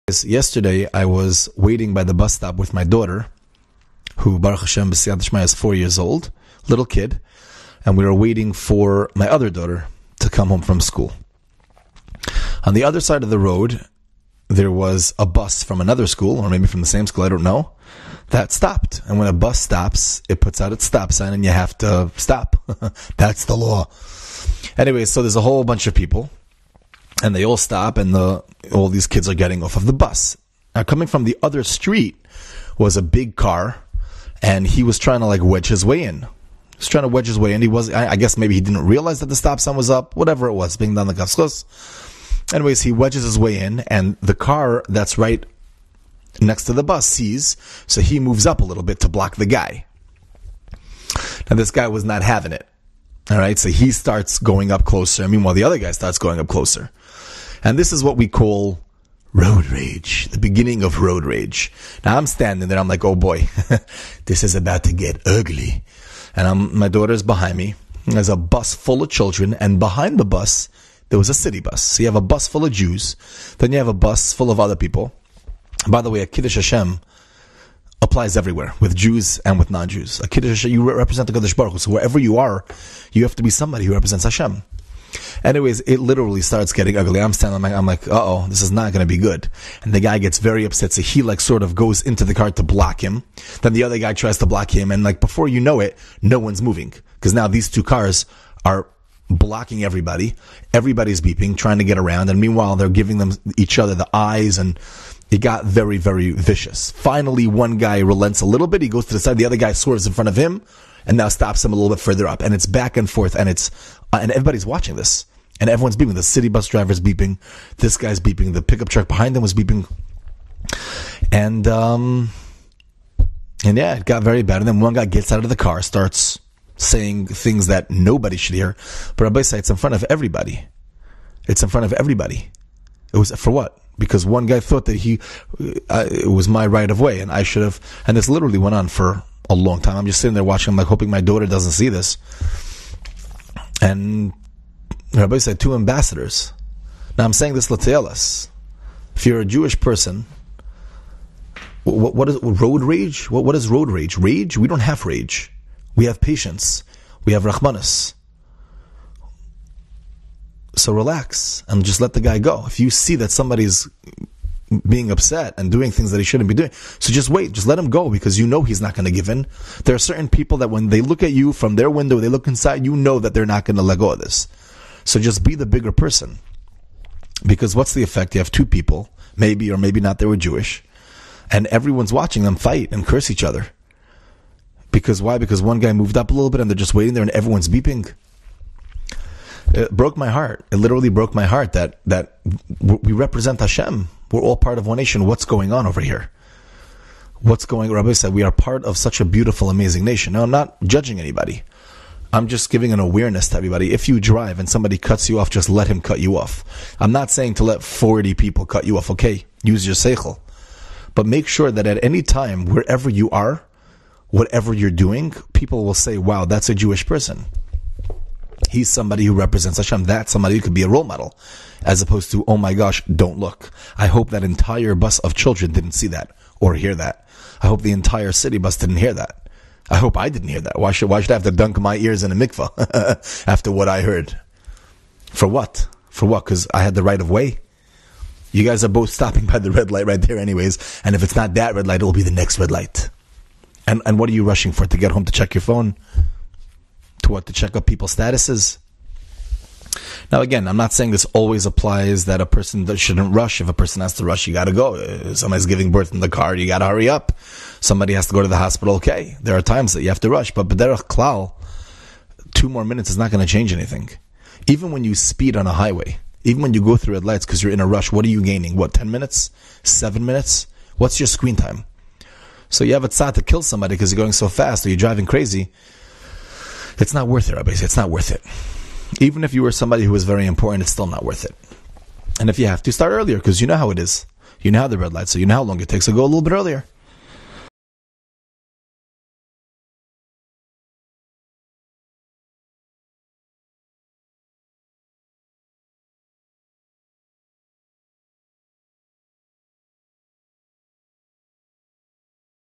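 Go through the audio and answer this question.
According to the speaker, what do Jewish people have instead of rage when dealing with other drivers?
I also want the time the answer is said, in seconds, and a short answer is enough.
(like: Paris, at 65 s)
Patience, at 155 s.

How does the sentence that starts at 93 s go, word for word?
Then the other guy tries to block him.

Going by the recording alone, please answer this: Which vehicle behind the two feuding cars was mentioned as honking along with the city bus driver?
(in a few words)
Pickup truck.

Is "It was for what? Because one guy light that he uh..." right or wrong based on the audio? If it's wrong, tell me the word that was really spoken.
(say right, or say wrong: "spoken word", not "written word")
wrong: "thought", not "light".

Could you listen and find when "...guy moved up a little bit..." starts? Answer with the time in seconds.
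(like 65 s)
185 s.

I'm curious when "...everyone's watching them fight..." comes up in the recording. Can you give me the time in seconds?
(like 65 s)
181 s.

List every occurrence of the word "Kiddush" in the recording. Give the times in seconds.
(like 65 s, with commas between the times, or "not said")
76 s, 80 s.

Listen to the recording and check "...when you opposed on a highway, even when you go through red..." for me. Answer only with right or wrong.
wrong.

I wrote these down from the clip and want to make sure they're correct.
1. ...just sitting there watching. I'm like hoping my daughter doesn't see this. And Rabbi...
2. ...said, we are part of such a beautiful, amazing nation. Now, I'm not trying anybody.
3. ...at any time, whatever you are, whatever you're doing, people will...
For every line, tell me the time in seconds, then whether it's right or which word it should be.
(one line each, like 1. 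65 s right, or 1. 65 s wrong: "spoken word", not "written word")
1. 140 s right
2. 198 s wrong: "judging", not "trying"
3. 211 s wrong: "wherever", not "whatever".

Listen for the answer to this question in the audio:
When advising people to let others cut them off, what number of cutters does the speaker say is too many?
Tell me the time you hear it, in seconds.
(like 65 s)
207 s.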